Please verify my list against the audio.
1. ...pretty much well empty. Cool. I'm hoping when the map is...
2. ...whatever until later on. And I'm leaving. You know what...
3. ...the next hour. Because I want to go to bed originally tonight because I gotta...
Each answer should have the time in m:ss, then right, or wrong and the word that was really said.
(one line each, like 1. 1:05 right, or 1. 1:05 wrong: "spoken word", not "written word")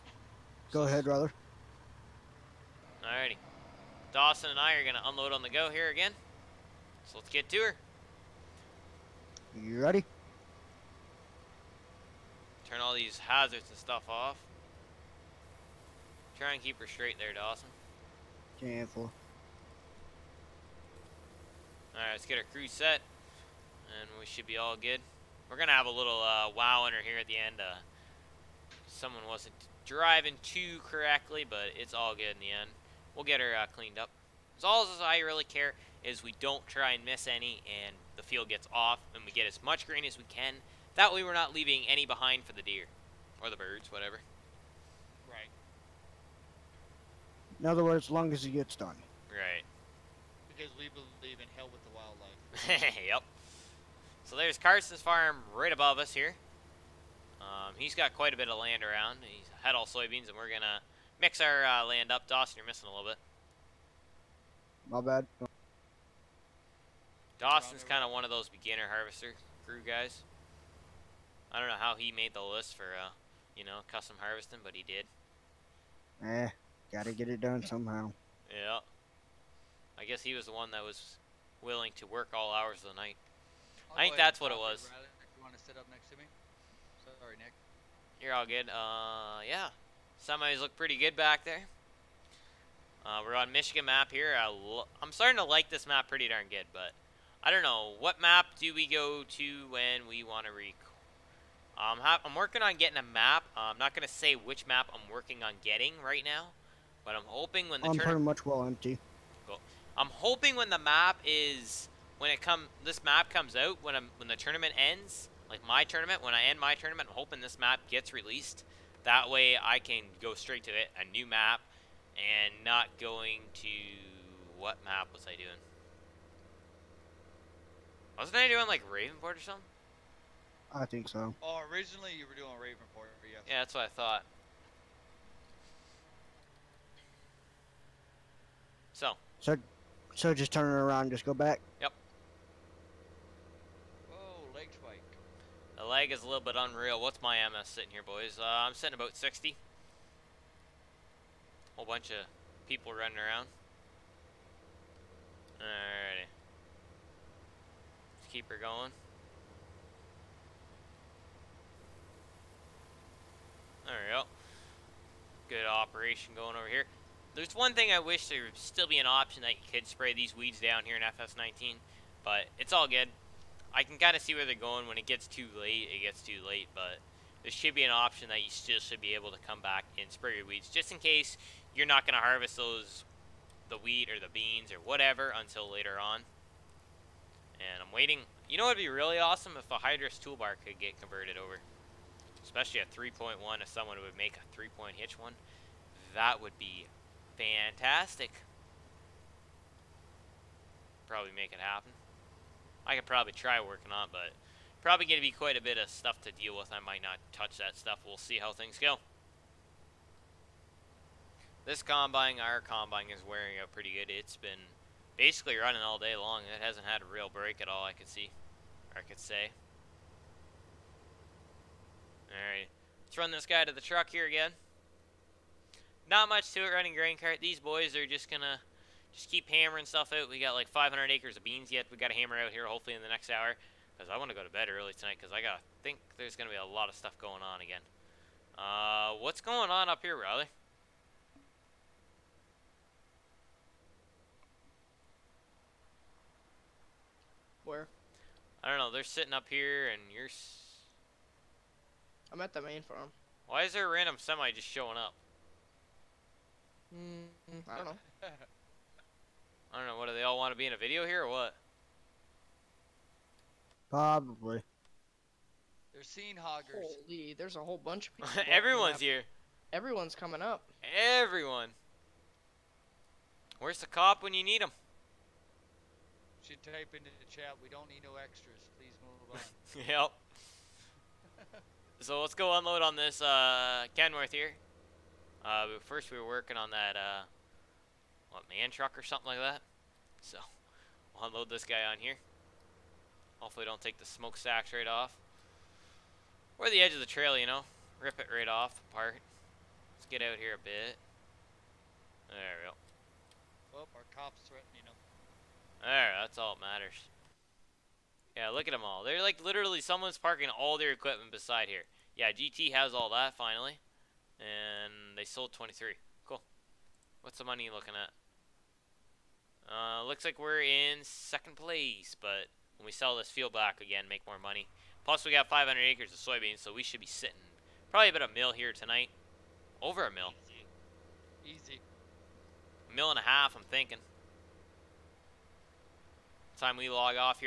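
1. 1:47 right
2. 3:04 wrong: "waiting", not "leaving"
3. 3:53 wrong: "early", not "originally".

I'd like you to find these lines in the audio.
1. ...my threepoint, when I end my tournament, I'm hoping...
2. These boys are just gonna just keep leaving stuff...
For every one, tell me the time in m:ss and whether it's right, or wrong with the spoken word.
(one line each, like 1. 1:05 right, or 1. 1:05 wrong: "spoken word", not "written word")
1. 1:55 wrong: "tournament", not "threepoint"
2. 3:47 wrong: "hammering", not "leaving".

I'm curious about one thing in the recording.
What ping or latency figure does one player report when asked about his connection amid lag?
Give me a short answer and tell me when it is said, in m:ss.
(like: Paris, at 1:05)
60, at 2:29.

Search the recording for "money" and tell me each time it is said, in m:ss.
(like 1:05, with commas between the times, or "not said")
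5:17, 5:24.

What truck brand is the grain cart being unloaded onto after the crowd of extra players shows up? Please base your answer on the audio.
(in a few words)
Kenworth.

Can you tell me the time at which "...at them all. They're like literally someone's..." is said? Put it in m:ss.
5:08.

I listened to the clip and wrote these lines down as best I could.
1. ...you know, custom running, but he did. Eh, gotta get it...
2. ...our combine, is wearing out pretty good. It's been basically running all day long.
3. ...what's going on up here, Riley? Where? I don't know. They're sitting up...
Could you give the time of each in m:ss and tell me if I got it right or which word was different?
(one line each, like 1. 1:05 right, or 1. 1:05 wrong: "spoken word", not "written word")
1. 1:13 wrong: "harvesting", not "running"
2. 3:32 right
3. 3:59 right.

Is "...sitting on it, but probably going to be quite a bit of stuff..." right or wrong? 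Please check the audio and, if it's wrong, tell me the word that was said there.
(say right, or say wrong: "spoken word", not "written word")
wrong: "working", not "sitting".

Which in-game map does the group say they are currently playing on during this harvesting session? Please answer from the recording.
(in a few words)
Michigan map.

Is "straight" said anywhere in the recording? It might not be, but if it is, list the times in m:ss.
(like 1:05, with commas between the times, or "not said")
0:16, 2:00.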